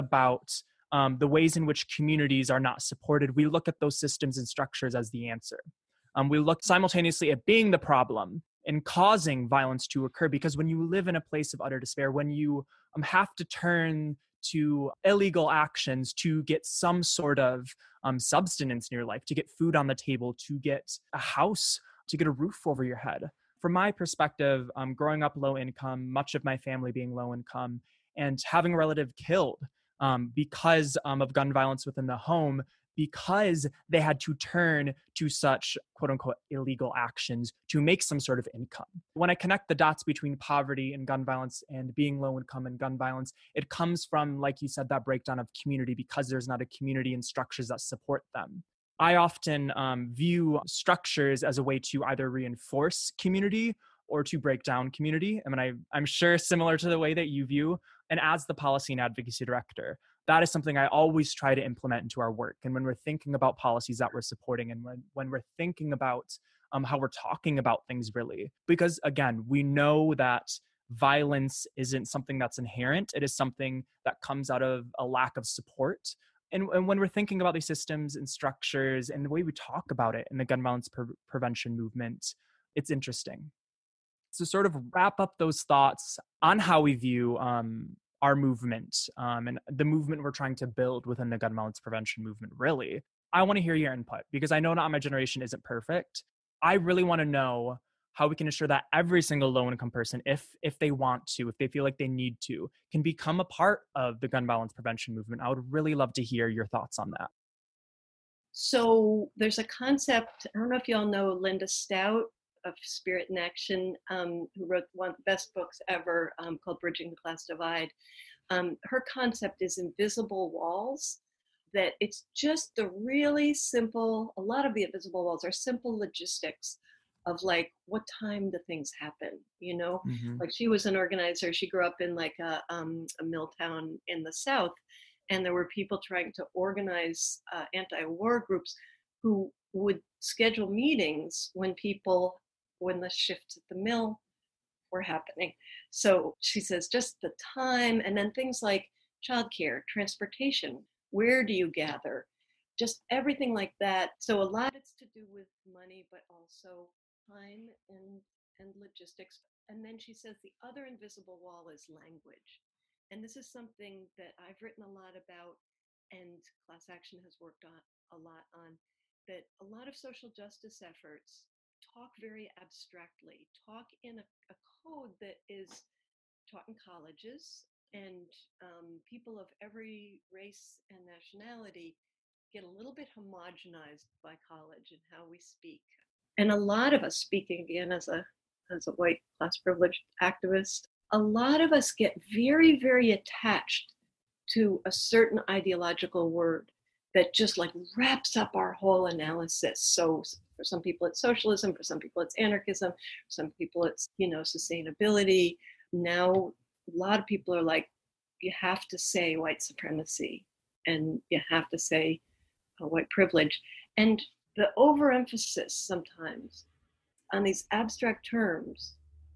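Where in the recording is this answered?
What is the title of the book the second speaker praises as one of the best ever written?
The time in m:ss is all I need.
1:56.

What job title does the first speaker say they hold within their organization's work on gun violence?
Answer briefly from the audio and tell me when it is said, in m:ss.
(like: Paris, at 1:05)
Policy and advocacy director, at 0:58.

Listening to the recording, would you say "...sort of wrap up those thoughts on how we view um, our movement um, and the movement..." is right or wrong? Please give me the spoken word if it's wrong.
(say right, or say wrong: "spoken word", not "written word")
right.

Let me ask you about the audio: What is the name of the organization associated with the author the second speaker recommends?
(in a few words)
Spirit in Action.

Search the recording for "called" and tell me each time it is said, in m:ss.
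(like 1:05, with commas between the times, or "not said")
1:56.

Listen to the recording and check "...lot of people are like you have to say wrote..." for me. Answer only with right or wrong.
wrong.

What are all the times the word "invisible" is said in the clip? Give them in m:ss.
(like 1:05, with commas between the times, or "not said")
1:59, 2:04, 2:40.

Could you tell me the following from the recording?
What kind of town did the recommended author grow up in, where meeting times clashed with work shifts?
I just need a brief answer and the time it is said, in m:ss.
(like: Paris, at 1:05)
A mill town, at 2:13.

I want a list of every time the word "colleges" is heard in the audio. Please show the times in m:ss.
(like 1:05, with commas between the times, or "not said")
2:56, 3:04.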